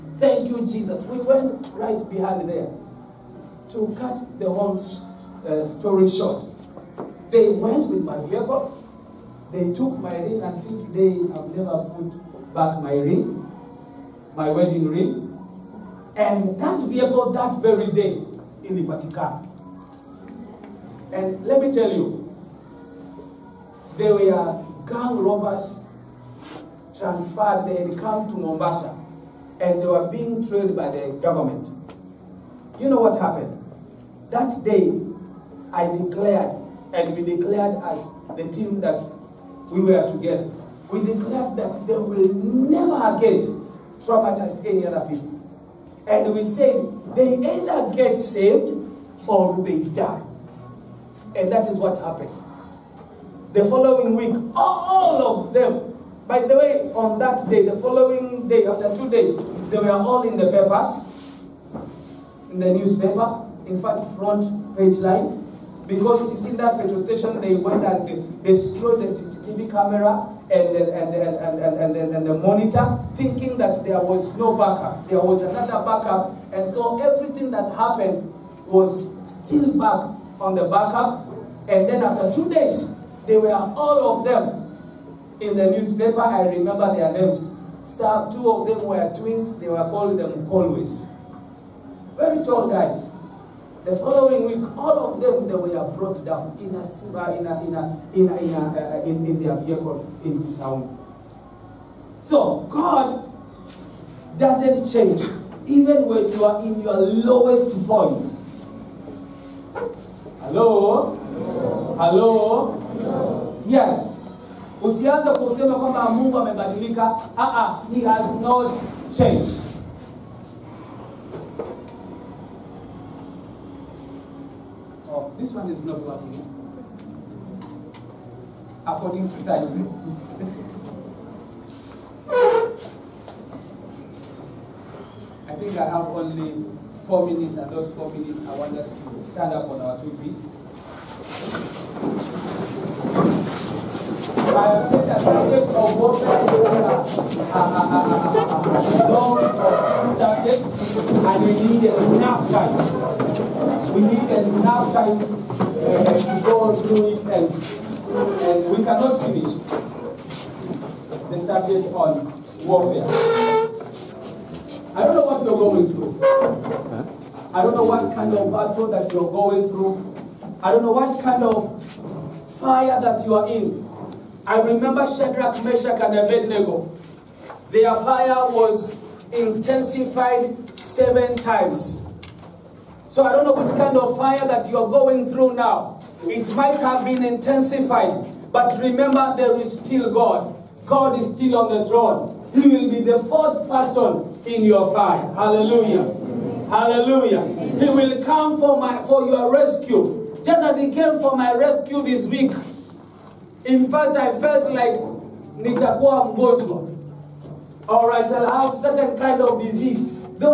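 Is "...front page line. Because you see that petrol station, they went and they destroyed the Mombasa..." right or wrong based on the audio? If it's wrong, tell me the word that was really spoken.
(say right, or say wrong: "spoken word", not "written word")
wrong: "CCTV", not "Mombasa".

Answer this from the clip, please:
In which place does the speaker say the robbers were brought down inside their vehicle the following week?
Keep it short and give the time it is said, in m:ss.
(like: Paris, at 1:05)
Kisauni, at 1:40.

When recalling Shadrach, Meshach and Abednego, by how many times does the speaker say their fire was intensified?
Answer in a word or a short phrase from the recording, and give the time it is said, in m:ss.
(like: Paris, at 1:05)
7, at 3:00.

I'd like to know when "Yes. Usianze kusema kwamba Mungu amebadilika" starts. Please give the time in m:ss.
1:53.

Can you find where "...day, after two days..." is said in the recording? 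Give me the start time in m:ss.
0:58.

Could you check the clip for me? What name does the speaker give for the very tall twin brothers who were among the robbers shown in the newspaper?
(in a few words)
Colways.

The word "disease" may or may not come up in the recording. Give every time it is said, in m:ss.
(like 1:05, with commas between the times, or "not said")
3:29.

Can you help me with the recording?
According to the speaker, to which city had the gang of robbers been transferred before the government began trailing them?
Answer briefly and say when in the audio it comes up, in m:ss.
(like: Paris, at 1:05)
Mombasa, at 0:28.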